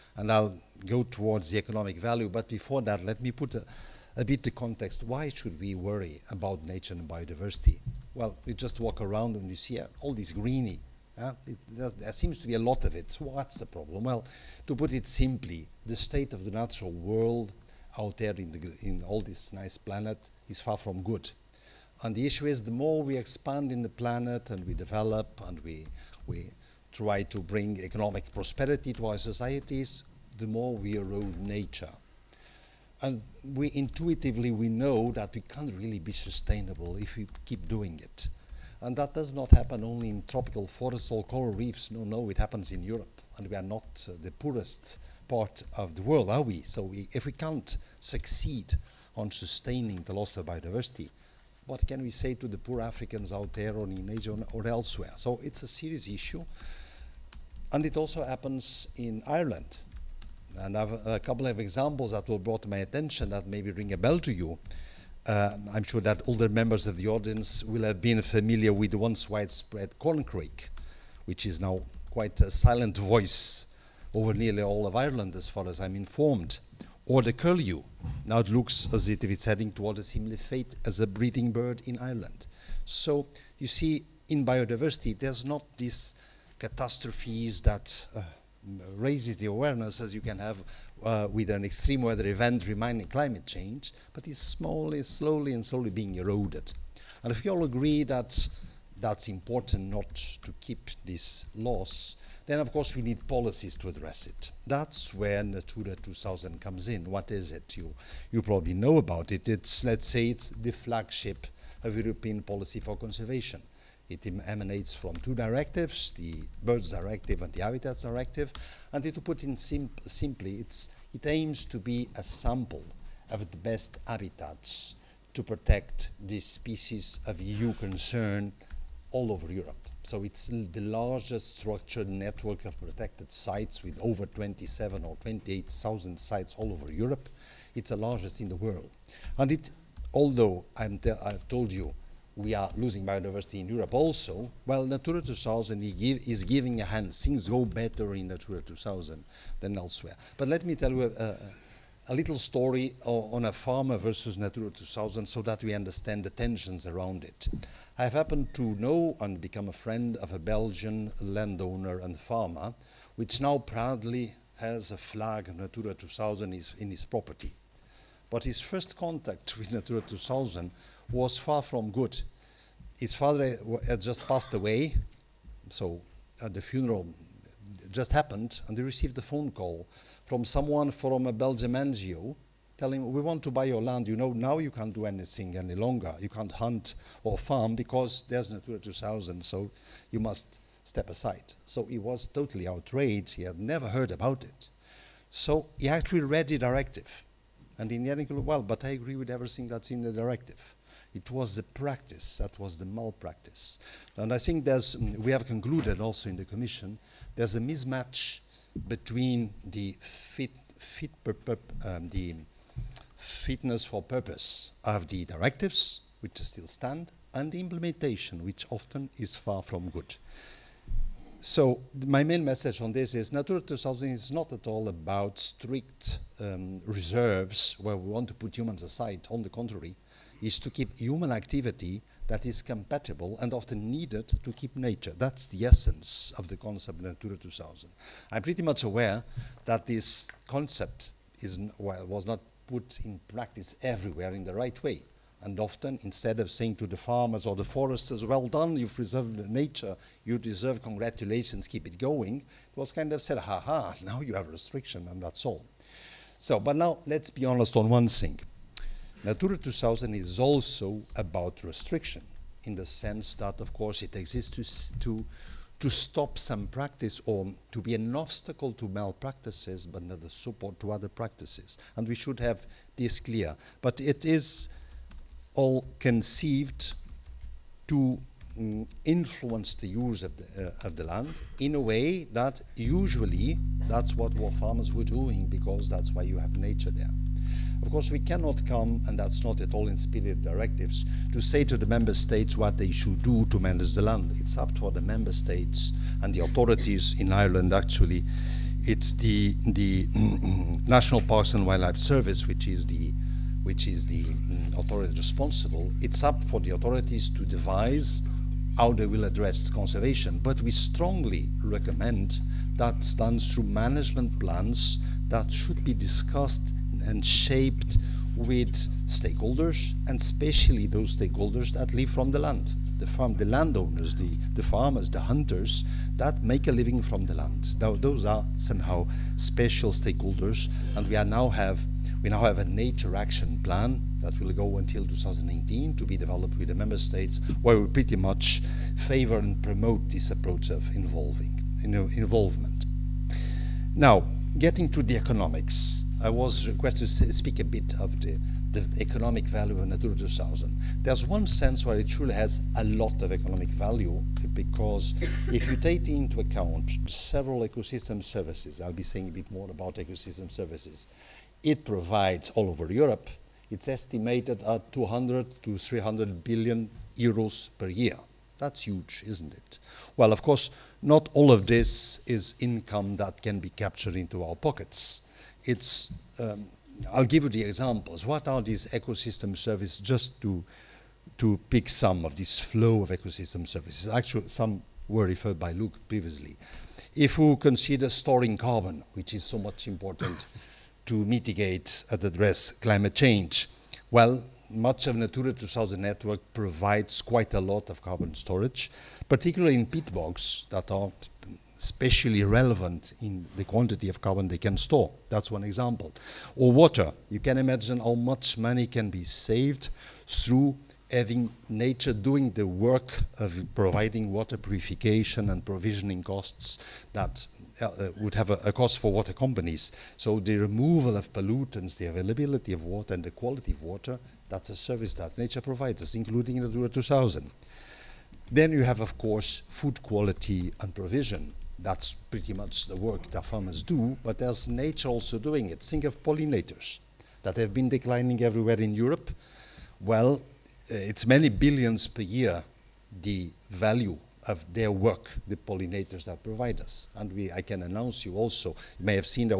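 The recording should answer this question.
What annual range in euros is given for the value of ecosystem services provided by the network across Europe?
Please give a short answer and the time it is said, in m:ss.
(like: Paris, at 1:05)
200 to 300 billion, at 6:04.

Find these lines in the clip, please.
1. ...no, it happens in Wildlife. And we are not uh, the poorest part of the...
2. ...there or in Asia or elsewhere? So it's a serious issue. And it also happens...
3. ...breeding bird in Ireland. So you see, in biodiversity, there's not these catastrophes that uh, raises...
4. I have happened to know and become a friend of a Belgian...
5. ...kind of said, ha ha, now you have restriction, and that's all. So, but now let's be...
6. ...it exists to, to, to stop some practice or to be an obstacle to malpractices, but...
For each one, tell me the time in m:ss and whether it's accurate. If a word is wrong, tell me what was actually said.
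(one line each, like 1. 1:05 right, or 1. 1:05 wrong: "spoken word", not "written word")
1. 0:42 wrong: "Europe", not "Wildlife"
2. 0:53 right
3. 1:21 right
4. 2:37 right
5. 4:12 right
6. 4:24 right.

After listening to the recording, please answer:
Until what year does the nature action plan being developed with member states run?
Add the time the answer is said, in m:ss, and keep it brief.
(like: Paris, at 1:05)
2019, at 5:35.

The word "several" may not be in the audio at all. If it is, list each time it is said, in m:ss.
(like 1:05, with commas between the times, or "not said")
5:57.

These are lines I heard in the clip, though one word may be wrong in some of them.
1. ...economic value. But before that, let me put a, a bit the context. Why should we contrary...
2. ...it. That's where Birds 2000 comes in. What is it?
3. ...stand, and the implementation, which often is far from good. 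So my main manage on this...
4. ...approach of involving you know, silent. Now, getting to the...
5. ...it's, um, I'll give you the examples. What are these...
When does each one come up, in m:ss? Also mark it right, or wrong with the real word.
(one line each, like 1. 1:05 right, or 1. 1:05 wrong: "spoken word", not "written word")
1. 0:01 wrong: "worry", not "contrary"
2. 1:44 wrong: "Natura", not "Birds"
3. 3:36 wrong: "message", not "manage"
4. 5:40 wrong: "involvement", not "silent"
5. 6:15 right.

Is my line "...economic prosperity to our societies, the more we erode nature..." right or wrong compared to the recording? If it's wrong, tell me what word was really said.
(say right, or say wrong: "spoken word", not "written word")
right.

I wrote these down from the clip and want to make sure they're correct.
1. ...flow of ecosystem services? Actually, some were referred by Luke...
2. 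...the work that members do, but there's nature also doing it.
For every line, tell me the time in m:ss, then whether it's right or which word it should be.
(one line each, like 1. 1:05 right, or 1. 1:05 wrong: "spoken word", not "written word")
1. 6:22 right
2. 7:12 wrong: "farmers", not "members".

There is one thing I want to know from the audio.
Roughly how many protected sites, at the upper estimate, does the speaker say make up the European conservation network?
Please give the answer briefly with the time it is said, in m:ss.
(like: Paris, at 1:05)
28,000, at 2:15.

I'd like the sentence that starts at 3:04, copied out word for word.
You know, now you can't do anything any longer.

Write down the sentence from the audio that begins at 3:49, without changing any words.
On the contrary, is to keep human activity that is compatible and often needed to keep nature.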